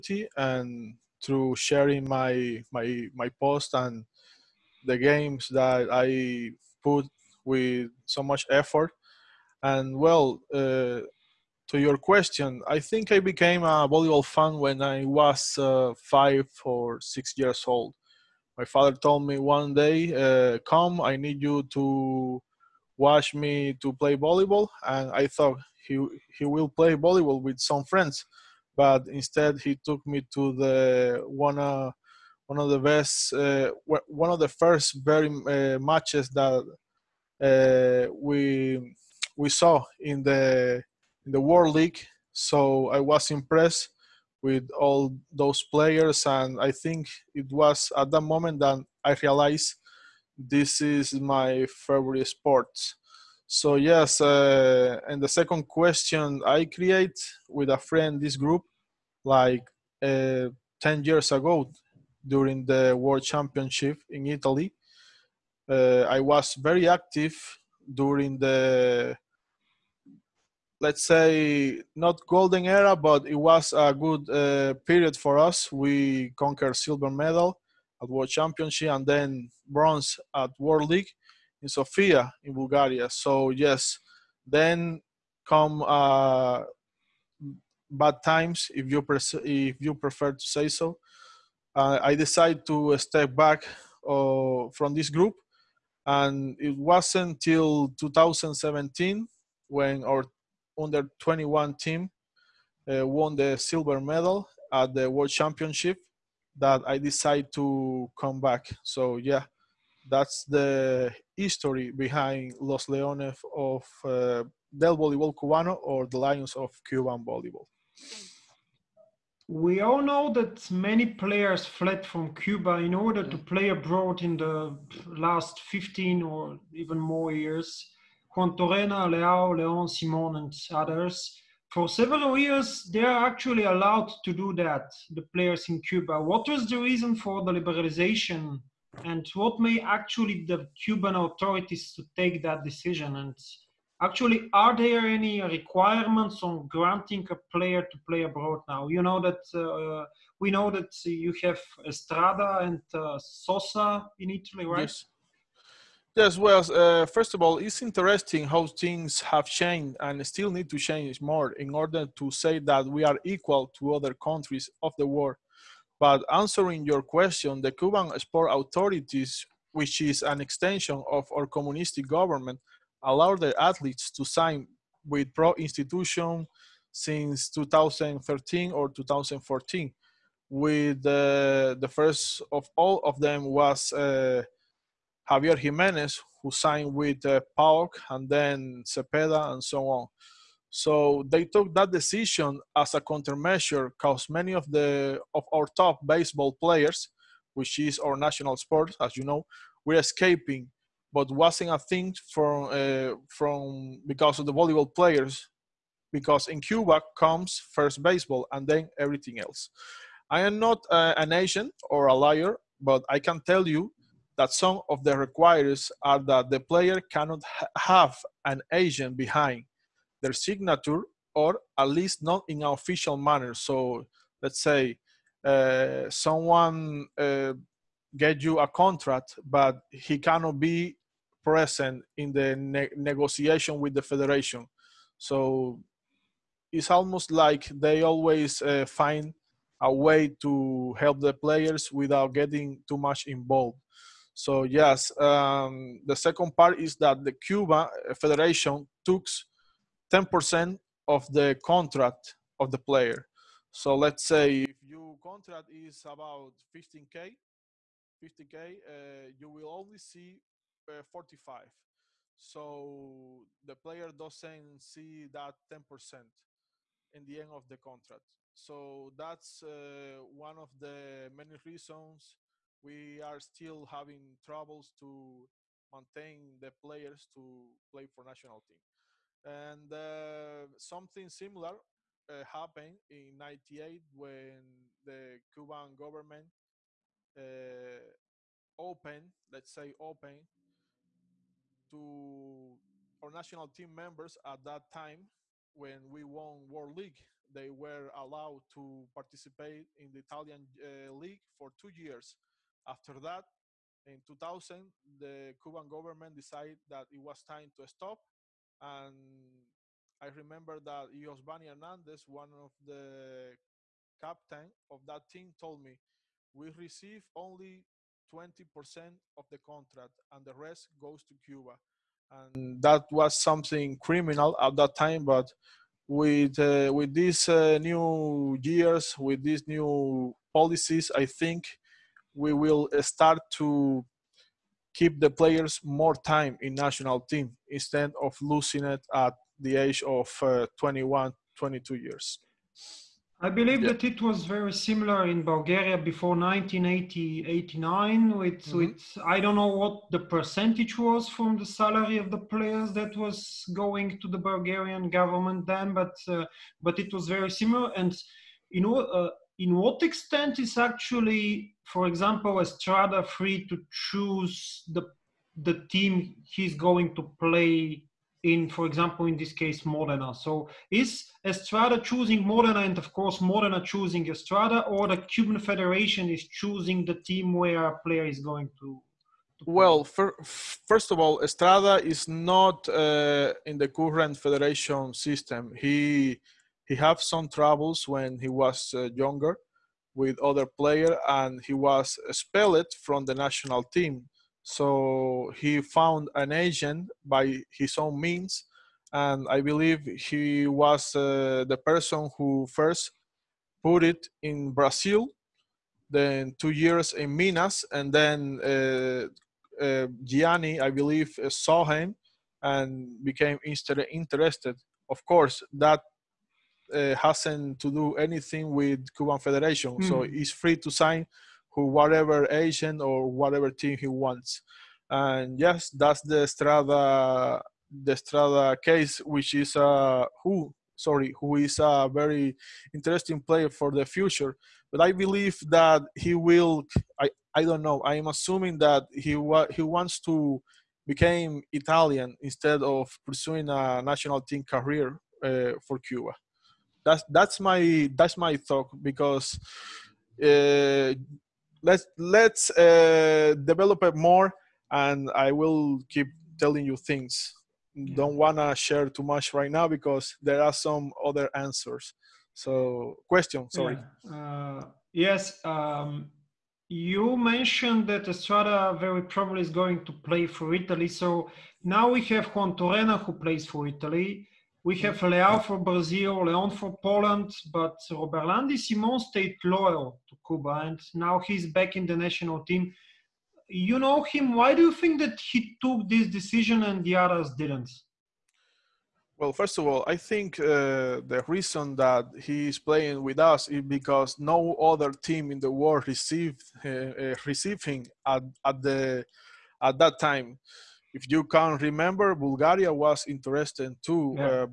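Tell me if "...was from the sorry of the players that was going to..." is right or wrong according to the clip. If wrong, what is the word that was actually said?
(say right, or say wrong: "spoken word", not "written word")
wrong: "salary", not "sorry".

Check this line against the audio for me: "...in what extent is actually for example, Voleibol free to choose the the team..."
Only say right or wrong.
wrong.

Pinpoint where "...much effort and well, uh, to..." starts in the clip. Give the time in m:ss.
0:08.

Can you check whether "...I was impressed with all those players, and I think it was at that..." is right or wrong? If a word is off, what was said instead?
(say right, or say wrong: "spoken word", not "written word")
right.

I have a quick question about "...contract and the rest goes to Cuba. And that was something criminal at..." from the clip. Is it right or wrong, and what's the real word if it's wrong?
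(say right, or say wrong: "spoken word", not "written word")
right.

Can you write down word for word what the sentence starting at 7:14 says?
But I believe that he will.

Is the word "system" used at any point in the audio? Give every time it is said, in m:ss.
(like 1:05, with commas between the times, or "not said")
6:25.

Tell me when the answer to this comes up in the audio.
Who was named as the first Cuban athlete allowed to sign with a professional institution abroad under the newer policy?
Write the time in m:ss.
3:05.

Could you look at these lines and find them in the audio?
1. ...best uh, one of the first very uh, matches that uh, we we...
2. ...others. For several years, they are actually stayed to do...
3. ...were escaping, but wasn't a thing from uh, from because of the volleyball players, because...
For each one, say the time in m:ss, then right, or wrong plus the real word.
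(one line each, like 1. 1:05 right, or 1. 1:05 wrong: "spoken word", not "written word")
1. 0:32 right
2. 2:10 wrong: "allowed", not "stayed"
3. 3:19 right.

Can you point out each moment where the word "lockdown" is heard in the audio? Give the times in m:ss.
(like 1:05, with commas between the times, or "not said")
not said.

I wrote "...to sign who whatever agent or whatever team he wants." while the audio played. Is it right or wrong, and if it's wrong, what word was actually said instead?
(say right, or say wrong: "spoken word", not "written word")
right.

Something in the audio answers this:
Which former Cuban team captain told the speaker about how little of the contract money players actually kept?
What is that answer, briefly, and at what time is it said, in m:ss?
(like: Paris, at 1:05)
Josvani Hernandez, at 5:11.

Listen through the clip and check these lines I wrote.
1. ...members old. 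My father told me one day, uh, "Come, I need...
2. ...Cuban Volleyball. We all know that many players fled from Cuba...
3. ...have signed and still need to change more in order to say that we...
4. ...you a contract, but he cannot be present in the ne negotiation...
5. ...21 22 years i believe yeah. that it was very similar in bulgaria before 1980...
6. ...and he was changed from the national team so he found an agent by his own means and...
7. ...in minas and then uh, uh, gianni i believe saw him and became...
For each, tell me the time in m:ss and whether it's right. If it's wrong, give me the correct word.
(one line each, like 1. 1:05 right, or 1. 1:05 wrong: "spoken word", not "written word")
1. 0:17 wrong: "years", not "members"
2. 1:56 right
3. 2:39 wrong: "changed", not "signed"
4. 3:48 right
5. 5:40 right
6. 6:31 wrong: "expelled", not "changed"
7. 6:47 right.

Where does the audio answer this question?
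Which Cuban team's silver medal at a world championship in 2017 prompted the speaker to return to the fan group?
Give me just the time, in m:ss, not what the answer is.
1:40.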